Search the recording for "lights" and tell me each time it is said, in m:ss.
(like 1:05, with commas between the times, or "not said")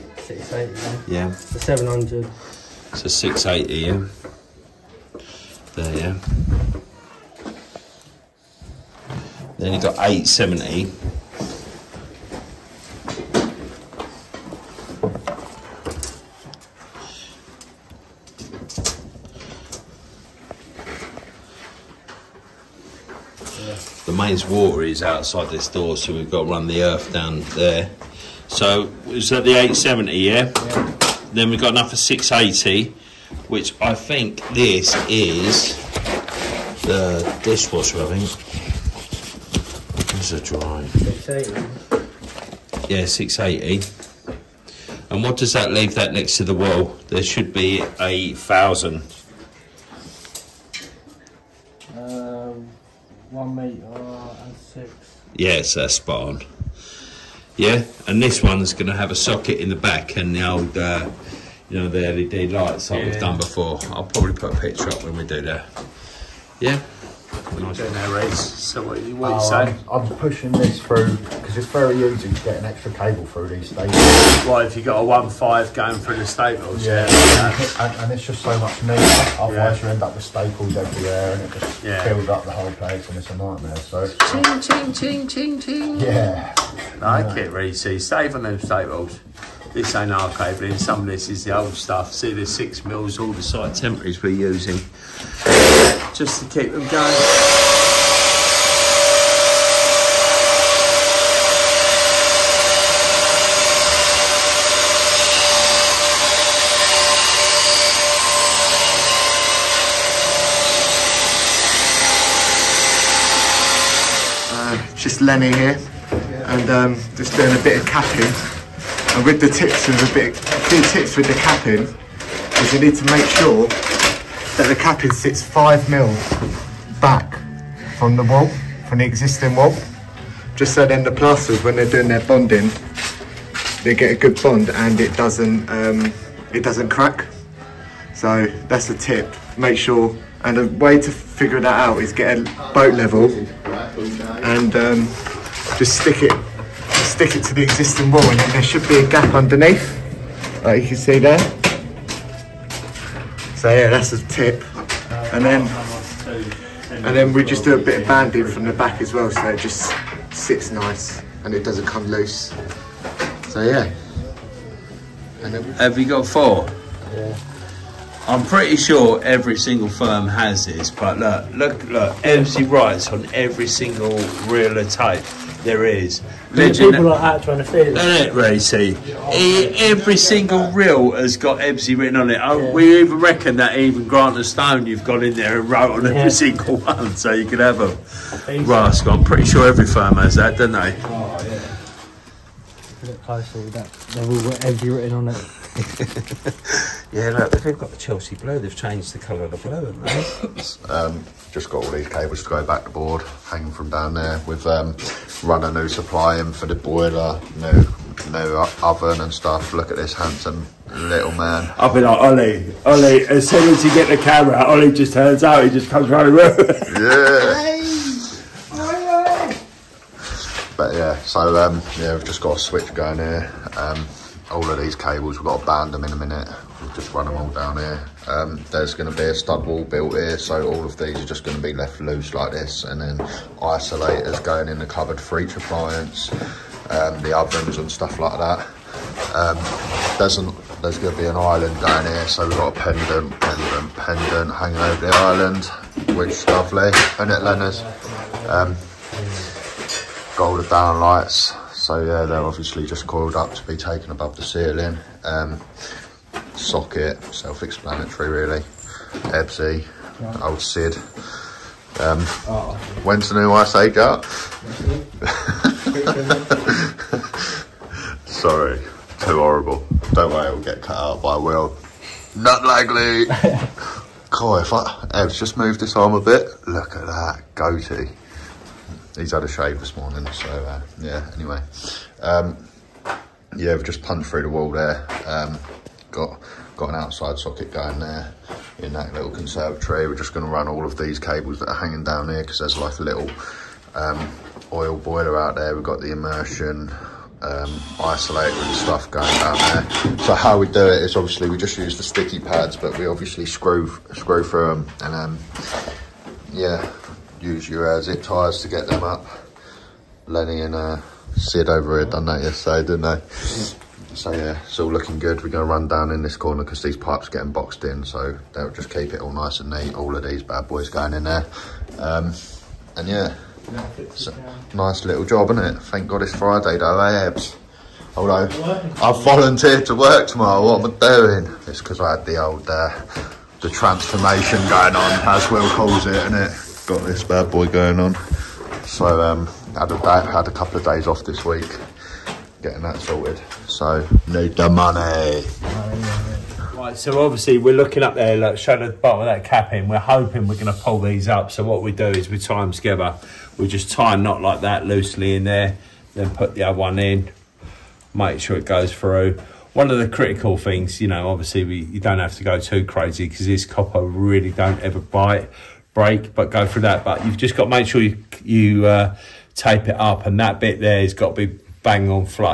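1:02, 4:11.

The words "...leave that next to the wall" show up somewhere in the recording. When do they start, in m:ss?
0:45.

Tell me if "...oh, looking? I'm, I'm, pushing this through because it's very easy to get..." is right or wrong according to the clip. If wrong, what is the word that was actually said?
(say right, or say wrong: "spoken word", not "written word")
wrong: "saying", not "looking".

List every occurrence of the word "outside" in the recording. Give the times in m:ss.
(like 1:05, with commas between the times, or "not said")
0:25, 4:46.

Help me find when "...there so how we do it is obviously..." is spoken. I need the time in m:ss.
4:59.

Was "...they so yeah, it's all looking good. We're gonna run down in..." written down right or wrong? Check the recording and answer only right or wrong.
right.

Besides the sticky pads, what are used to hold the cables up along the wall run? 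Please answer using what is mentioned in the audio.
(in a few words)
zip ties.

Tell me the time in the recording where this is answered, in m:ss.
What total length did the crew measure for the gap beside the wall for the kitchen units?
0:53.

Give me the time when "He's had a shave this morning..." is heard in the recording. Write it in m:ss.
4:39.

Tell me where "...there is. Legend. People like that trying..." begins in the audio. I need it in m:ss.
2:55.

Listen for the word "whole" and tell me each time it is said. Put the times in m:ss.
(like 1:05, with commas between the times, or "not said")
1:22.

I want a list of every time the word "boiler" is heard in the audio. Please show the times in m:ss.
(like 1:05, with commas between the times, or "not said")
3:26, 4:54.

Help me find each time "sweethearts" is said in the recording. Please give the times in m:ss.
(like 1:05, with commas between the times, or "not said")
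not said.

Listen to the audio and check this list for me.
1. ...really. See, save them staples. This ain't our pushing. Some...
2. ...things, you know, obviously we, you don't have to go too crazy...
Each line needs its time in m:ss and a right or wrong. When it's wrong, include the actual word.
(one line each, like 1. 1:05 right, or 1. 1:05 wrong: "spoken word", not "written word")
1. 1:27 wrong: "cabling", not "pushing"
2. 6:00 right.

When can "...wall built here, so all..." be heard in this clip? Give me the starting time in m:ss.
3:49.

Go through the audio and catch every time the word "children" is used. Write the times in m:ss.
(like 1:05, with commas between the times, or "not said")
not said.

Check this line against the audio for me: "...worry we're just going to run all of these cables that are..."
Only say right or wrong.
wrong.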